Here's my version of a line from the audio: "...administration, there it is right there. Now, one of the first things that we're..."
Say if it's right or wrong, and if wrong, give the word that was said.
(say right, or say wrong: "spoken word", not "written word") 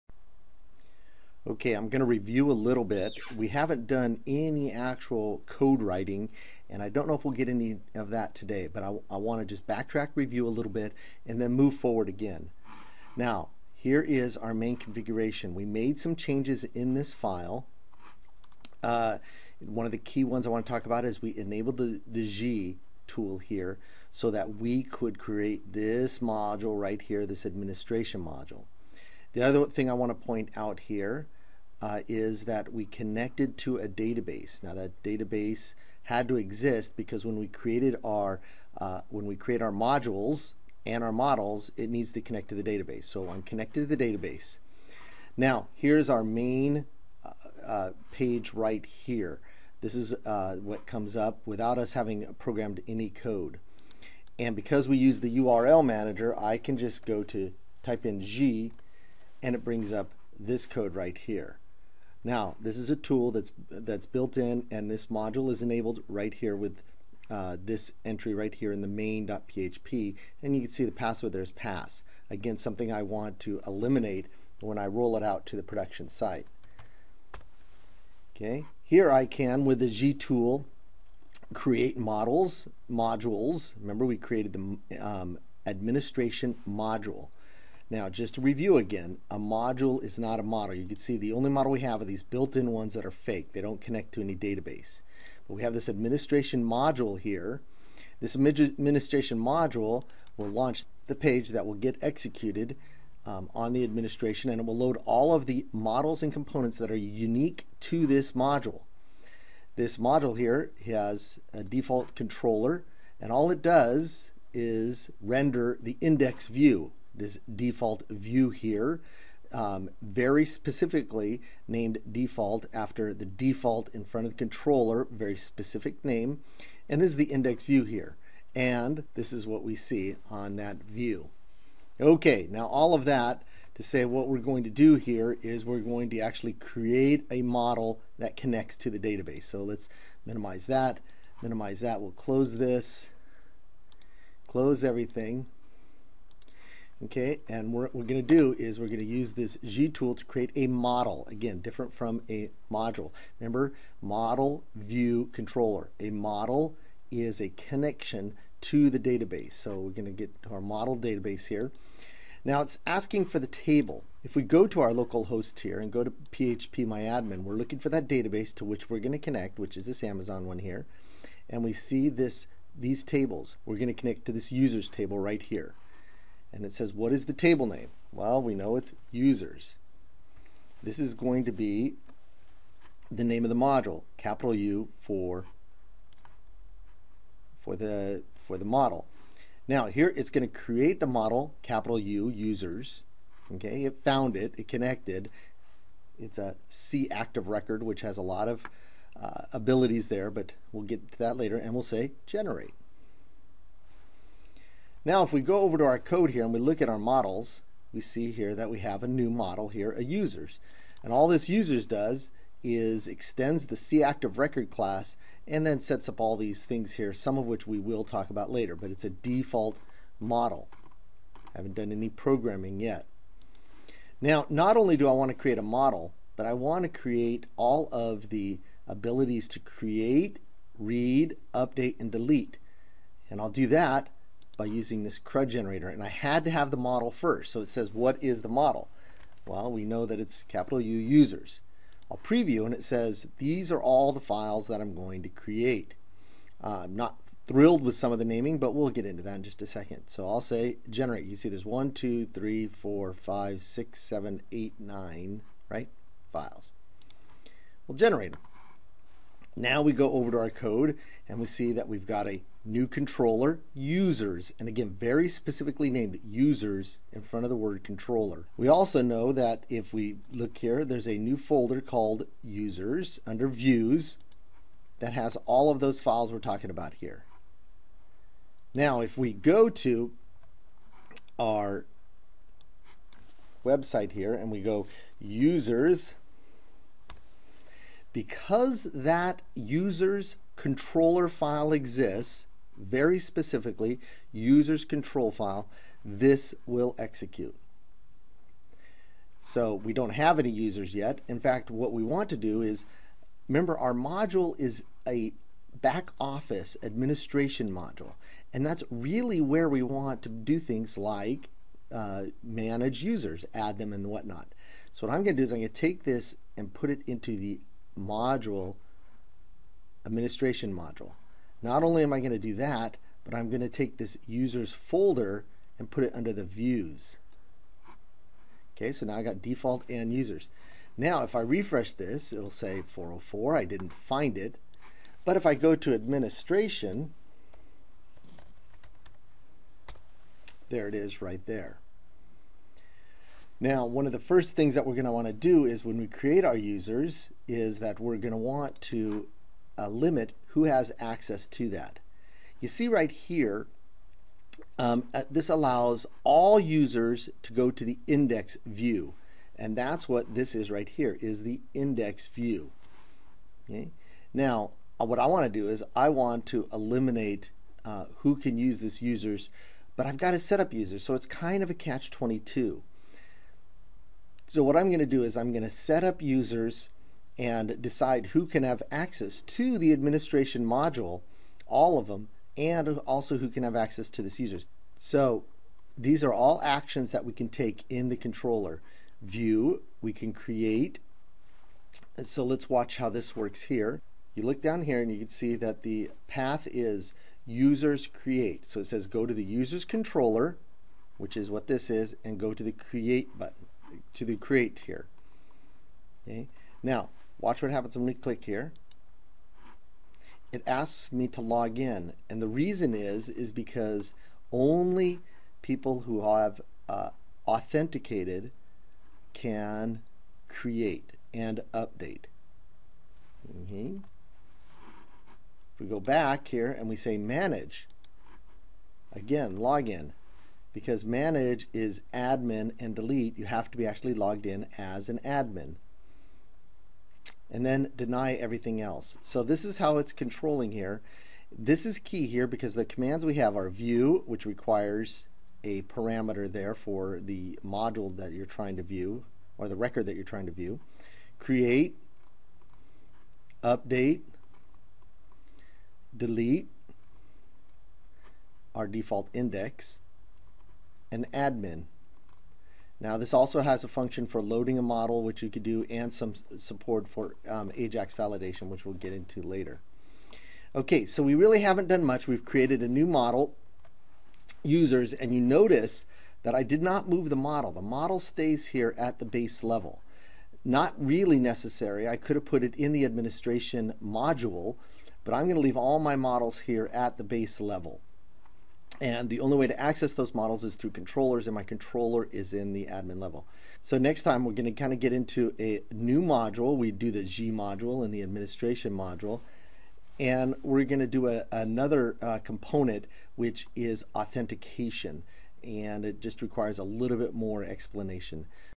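right.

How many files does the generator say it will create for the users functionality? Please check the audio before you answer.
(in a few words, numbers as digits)
9.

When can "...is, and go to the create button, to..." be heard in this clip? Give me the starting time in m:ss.
6:41.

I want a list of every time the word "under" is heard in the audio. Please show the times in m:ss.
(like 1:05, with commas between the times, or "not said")
4:33, 5:26.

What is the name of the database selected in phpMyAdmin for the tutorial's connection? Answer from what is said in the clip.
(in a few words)
Amazon.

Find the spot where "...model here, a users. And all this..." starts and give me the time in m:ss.
3:29.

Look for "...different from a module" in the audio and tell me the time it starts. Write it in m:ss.
2:31.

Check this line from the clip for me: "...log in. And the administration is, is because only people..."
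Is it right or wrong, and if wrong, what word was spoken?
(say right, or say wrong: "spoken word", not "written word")
wrong: "reason", not "administration".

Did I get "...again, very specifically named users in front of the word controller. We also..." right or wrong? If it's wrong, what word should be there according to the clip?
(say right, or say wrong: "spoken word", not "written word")
right.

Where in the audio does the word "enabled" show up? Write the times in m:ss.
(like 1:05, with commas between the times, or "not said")
0:21, 1:05.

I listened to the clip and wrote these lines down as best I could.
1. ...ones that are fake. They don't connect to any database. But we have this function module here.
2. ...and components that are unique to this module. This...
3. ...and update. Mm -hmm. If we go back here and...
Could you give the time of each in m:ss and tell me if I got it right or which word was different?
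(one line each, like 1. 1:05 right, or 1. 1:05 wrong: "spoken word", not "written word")
1. 1:32 wrong: "administration", not "function"
2. 1:46 right
3. 7:01 right.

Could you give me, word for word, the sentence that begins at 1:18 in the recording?
Okay, here I can, with the Gii tool, create models, modules.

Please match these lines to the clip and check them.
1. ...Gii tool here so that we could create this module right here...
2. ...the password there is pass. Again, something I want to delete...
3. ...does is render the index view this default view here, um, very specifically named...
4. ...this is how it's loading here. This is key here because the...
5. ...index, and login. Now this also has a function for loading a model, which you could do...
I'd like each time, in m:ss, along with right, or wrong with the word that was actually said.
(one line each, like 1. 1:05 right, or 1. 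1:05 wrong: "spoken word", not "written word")
1. 0:22 right
2. 1:10 wrong: "eliminate", not "delete"
3. 1:53 right
4. 7:19 wrong: "controlling", not "loading"
5. 7:39 wrong: "admin", not "login".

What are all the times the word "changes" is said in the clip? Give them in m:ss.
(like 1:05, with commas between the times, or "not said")
0:16.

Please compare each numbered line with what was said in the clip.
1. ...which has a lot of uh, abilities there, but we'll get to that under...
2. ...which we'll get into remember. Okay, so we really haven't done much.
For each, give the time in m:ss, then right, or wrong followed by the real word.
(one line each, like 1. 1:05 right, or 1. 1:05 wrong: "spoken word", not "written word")
1. 3:17 wrong: "later", not "under"
2. 7:48 wrong: "later", not "remember".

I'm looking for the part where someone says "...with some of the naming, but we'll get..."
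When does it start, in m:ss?
4:07.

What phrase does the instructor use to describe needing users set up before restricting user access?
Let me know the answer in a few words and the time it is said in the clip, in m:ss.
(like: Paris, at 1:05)
catch-22, at 6:11.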